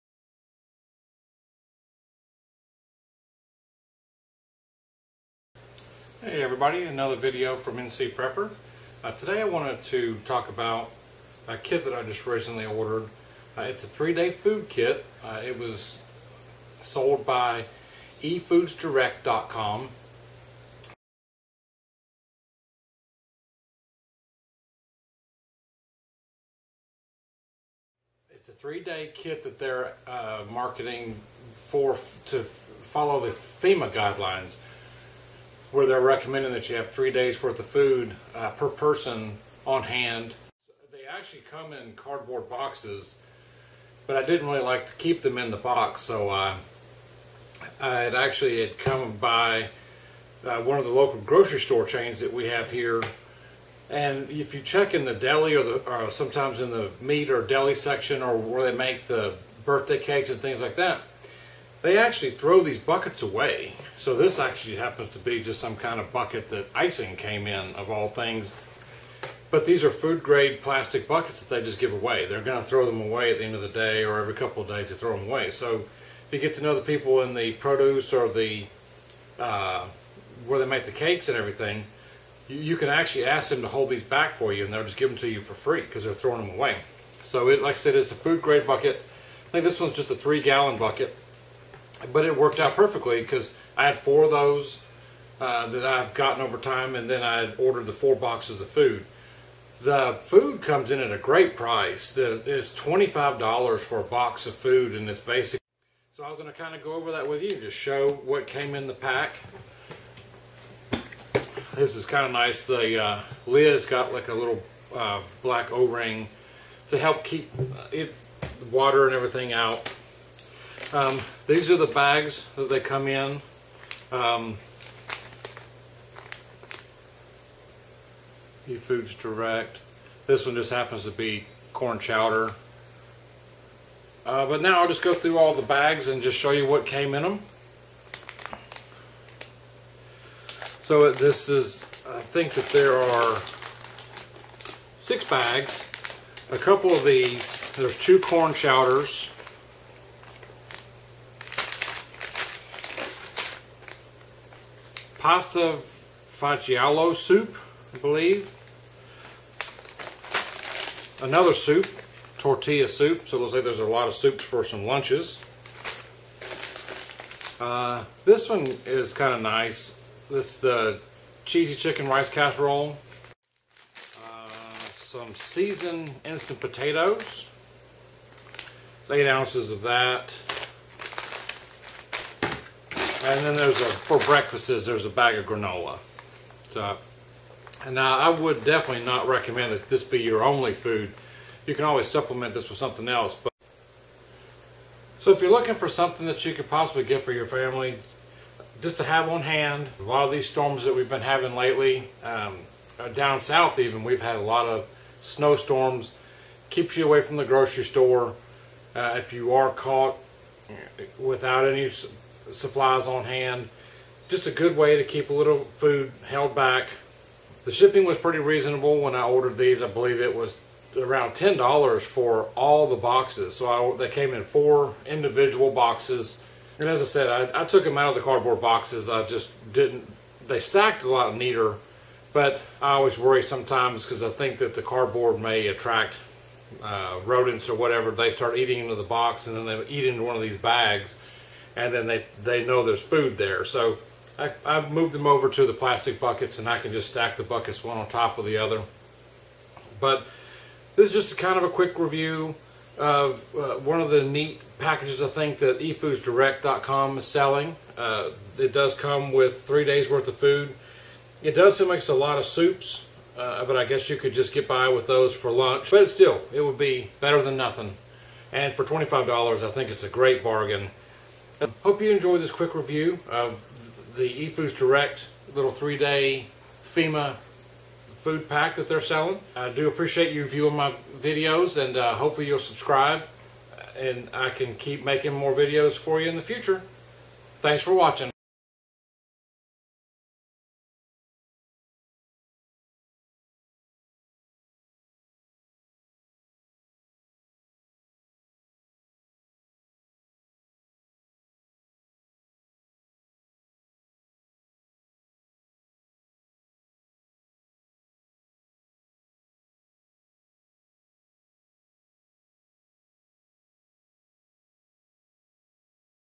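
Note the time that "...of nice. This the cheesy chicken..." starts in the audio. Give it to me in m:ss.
2:49.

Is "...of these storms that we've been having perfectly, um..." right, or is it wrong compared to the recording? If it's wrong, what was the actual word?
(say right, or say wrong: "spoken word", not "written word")
wrong: "lately", not "perfectly".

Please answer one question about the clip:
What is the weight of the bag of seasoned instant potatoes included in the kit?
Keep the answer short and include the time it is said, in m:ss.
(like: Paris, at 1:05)
8 ounces, at 2:59.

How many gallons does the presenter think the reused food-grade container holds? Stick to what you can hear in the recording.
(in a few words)
3 gallons.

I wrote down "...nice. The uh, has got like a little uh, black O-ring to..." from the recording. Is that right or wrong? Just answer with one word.
right.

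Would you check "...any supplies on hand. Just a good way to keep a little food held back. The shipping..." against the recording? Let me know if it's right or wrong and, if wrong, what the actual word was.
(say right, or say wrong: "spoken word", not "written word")
right.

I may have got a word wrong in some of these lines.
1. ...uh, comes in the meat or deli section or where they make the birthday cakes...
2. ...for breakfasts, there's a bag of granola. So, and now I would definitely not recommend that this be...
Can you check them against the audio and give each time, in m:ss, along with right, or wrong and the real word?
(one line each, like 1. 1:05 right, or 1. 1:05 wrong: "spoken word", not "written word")
1. 0:56 wrong: "sometimes", not "comes"
2. 3:03 right.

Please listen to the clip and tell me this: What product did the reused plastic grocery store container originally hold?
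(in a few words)
Icing.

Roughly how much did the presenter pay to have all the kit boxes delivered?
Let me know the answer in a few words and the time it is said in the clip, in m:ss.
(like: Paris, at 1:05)
$10, at 3:41.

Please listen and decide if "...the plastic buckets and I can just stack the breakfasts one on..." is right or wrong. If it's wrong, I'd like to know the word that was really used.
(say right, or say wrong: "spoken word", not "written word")
wrong: "buckets", not "breakfasts".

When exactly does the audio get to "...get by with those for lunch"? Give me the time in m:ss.
4:24.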